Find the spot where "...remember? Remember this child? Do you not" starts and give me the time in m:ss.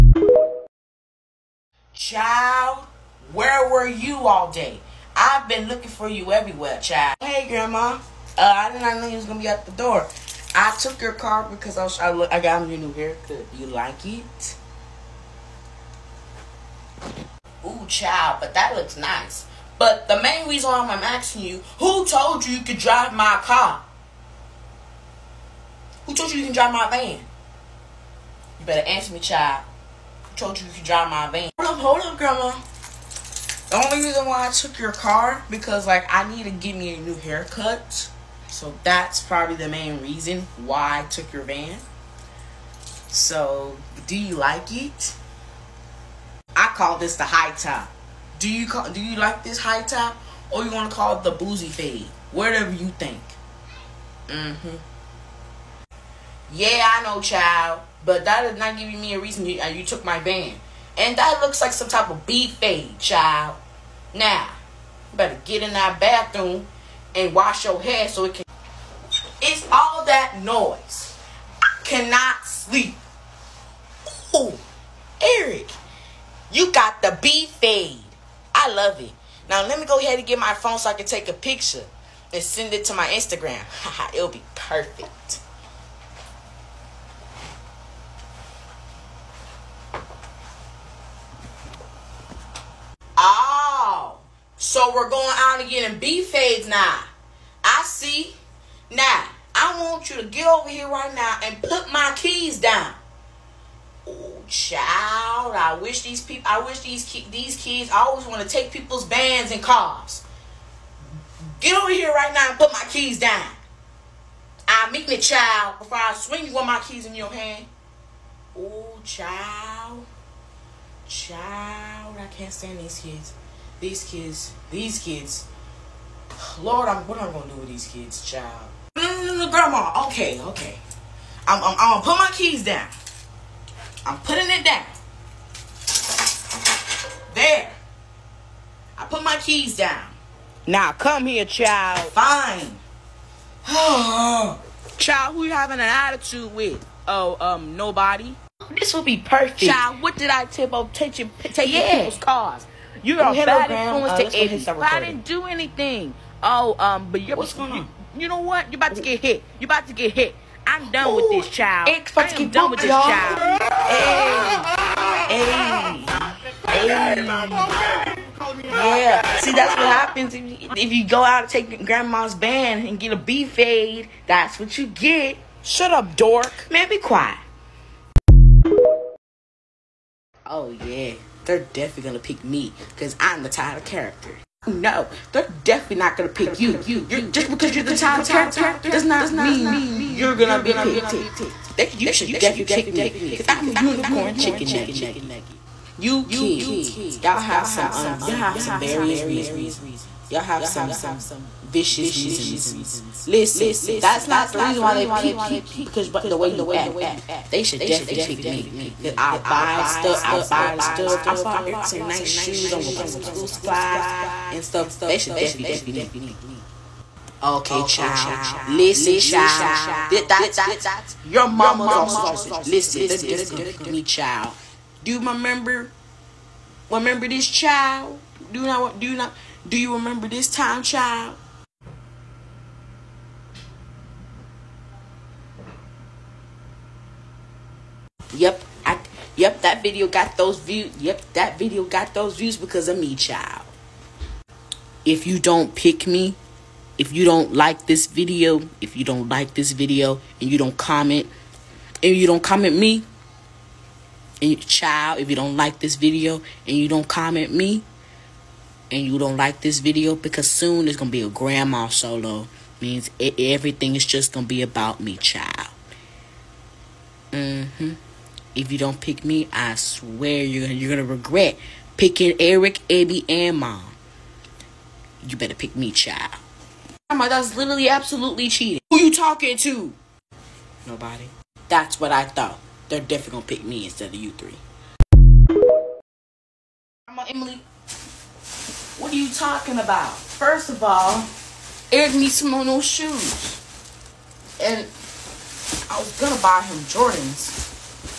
3:45.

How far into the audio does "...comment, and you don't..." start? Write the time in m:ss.
4:10.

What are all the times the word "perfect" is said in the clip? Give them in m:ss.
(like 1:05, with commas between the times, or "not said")
1:24, 2:29.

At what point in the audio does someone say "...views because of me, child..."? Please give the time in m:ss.
4:02.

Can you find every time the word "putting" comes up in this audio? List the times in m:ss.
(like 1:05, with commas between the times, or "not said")
2:14.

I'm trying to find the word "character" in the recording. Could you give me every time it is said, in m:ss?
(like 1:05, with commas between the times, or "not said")
3:03, 3:08.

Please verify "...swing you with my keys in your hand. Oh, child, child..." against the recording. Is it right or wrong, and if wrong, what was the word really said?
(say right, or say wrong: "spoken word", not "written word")
right.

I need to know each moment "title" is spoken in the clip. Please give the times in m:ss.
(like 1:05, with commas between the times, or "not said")
3:03, 3:07.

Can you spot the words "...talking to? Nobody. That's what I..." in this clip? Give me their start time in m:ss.
4:39.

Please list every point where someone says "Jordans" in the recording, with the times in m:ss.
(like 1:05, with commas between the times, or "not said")
4:56.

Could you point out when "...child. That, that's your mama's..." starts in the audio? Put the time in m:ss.
3:39.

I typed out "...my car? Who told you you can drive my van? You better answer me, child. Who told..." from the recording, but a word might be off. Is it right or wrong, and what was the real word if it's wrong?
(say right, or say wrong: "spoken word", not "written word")
right.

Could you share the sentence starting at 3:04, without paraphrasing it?
No, they're definitely not gonna pick you.